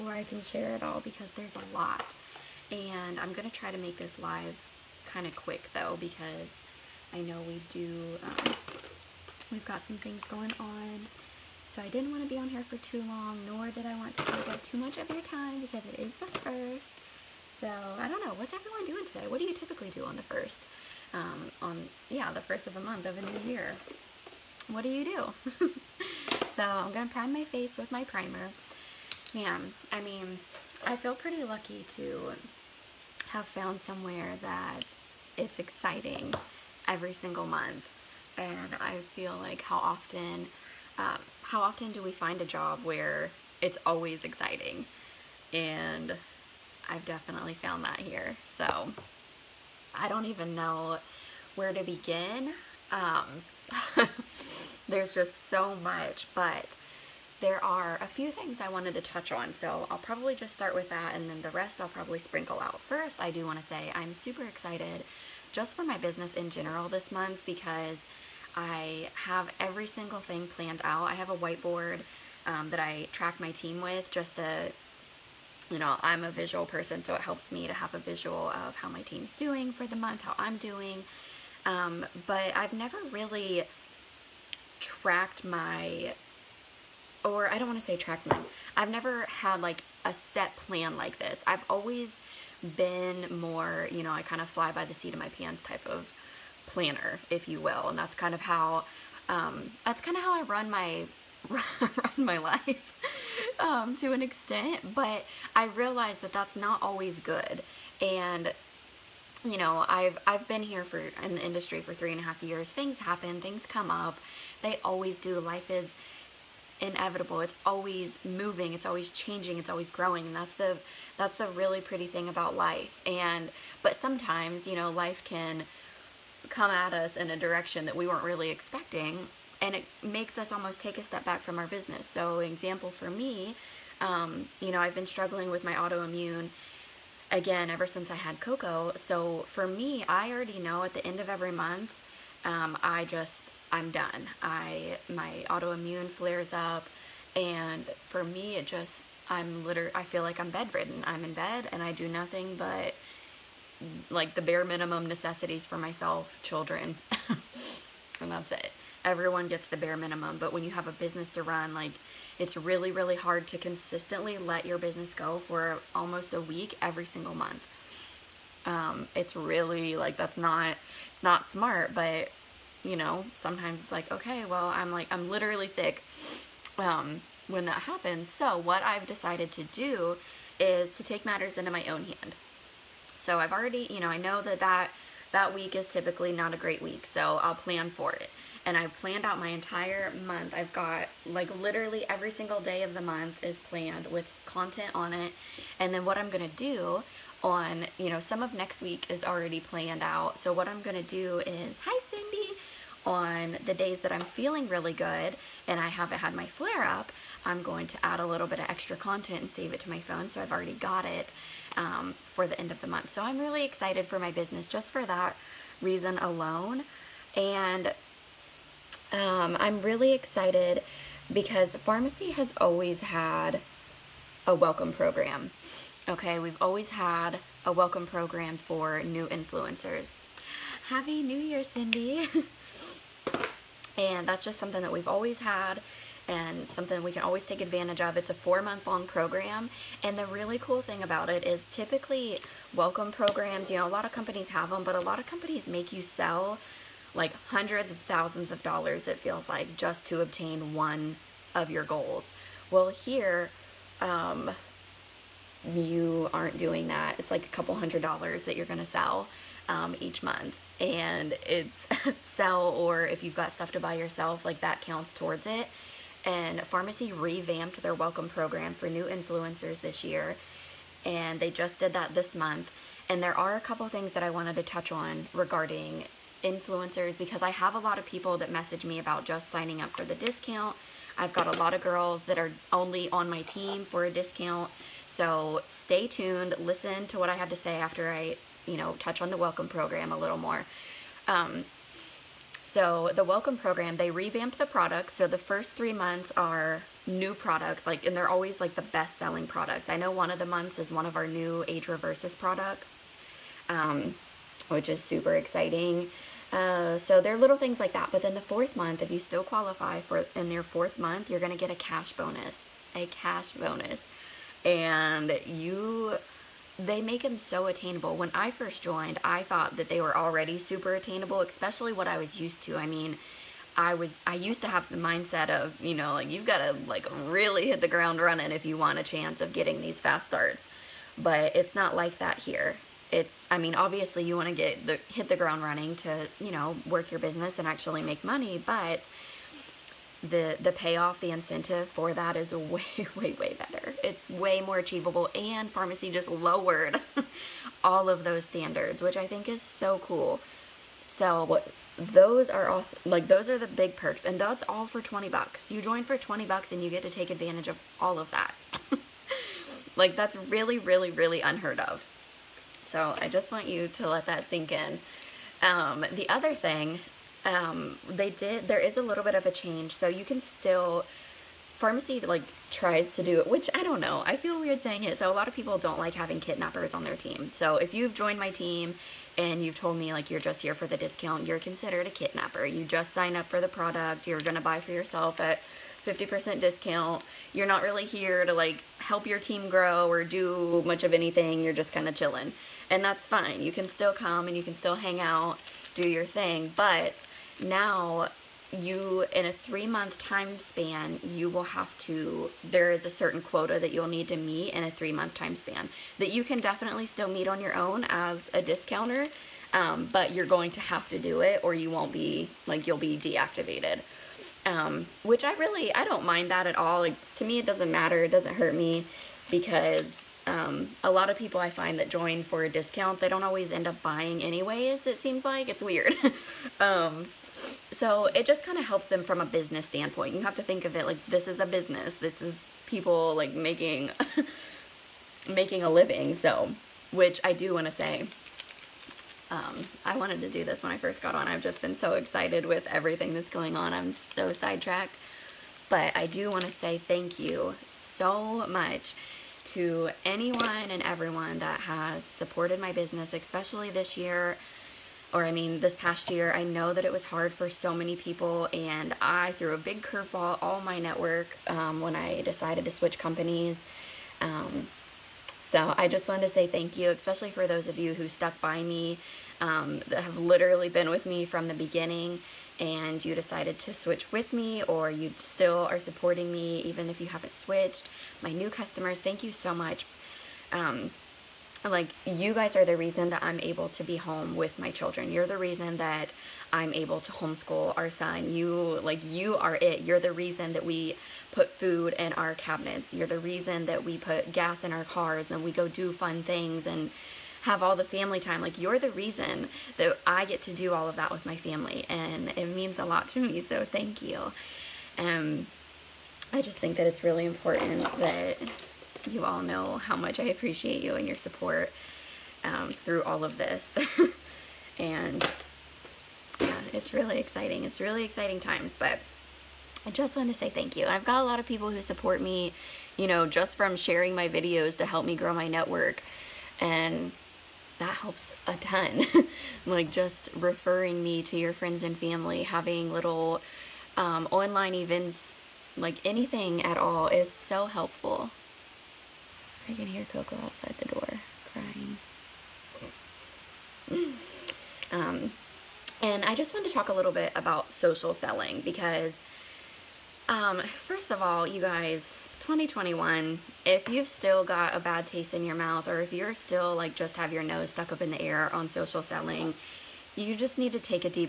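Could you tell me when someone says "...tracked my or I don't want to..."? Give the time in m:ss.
1:24.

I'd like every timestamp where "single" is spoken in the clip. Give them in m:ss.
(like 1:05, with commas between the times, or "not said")
0:37, 1:09, 2:47, 3:12.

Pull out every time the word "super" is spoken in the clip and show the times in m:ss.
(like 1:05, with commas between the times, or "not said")
1:04, 5:05, 5:20.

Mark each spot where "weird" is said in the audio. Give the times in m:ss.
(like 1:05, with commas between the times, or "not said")
6:14, 7:05.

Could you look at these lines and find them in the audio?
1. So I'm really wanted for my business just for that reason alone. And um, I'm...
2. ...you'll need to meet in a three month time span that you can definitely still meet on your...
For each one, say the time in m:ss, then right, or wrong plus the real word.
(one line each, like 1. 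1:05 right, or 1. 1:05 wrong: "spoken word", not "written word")
1. 3:33 wrong: "excited", not "wanted"
2. 6:43 right.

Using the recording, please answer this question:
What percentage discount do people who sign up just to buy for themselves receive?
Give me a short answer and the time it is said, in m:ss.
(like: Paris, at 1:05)
50%, at 6:26.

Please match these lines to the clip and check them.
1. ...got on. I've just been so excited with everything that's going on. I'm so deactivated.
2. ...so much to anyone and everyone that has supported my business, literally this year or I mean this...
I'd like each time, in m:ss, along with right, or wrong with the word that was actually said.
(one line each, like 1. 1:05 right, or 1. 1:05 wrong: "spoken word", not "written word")
1. 7:21 wrong: "sidetracked", not "deactivated"
2. 7:27 wrong: "especially", not "literally".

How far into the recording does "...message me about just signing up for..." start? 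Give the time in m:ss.
4:38.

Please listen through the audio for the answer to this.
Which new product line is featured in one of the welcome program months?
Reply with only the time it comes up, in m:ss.
5:01.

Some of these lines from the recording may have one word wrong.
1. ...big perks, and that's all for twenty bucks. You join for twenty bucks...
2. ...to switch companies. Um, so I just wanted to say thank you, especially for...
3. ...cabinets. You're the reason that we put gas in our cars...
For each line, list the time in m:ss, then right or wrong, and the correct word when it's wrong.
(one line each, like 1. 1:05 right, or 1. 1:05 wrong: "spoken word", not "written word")
1. 5:53 right
2. 7:42 right
3. 8:12 right.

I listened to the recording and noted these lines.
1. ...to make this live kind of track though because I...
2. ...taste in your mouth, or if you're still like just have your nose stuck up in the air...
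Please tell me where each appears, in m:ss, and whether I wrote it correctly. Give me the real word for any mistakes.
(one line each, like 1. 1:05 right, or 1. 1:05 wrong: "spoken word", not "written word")
1. 0:03 wrong: "quick", not "track"
2. 9:15 right.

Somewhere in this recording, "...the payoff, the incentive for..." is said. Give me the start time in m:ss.
5:40.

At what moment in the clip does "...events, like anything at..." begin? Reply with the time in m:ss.
8:54.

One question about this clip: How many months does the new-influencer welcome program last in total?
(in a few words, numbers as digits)
4 months.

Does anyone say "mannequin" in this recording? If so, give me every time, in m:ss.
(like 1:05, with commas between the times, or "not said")
not said.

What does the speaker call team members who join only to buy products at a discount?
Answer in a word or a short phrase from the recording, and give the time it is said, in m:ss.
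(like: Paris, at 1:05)
kidnapper, at 6:22.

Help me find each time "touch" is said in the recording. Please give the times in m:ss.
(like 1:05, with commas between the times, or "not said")
0:59, 4:34, 4:48.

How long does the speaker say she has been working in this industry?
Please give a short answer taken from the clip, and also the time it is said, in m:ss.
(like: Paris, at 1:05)
3.5 years, at 1:51.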